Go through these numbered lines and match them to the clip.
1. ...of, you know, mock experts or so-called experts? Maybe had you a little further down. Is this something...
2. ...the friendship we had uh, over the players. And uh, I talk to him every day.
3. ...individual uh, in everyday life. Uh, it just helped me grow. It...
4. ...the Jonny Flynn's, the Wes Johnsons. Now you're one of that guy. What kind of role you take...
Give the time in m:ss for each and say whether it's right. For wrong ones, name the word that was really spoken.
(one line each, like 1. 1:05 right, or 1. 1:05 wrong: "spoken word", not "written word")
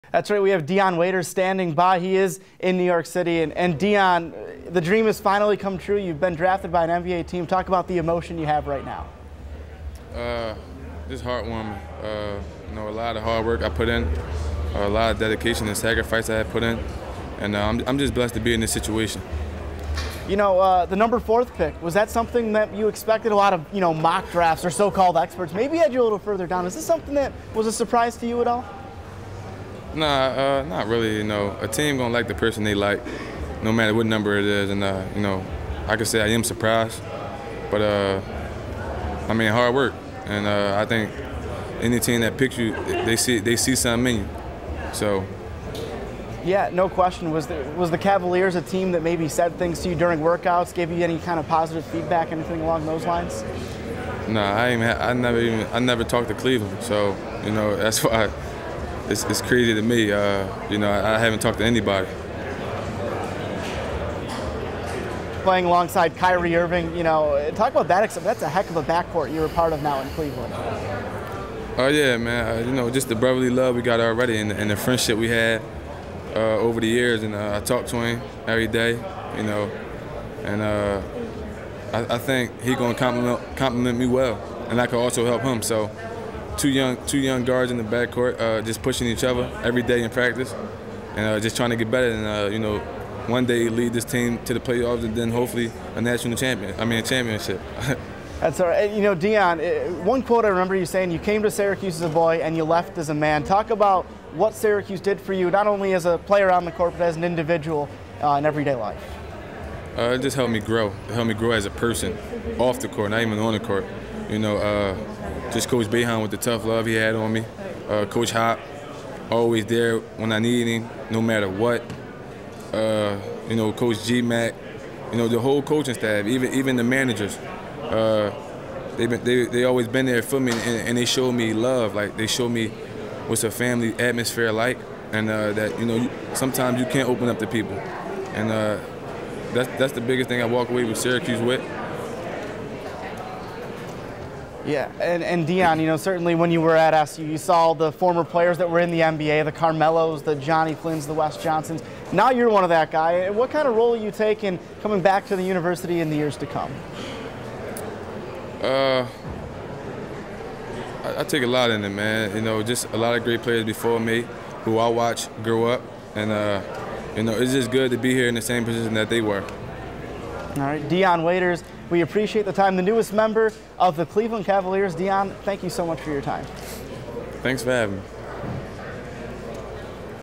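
1. 0:23 wrong: "drafts", not "experts"
2. 1:14 wrong: "years", not "players"
3. 1:47 right
4. 2:30 right.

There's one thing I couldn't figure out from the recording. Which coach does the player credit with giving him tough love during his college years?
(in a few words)
Coach Boeheim.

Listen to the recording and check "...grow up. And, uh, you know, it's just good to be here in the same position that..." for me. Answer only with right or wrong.
right.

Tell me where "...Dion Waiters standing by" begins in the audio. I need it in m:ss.
0:00.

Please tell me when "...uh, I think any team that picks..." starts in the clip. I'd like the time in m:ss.
0:40.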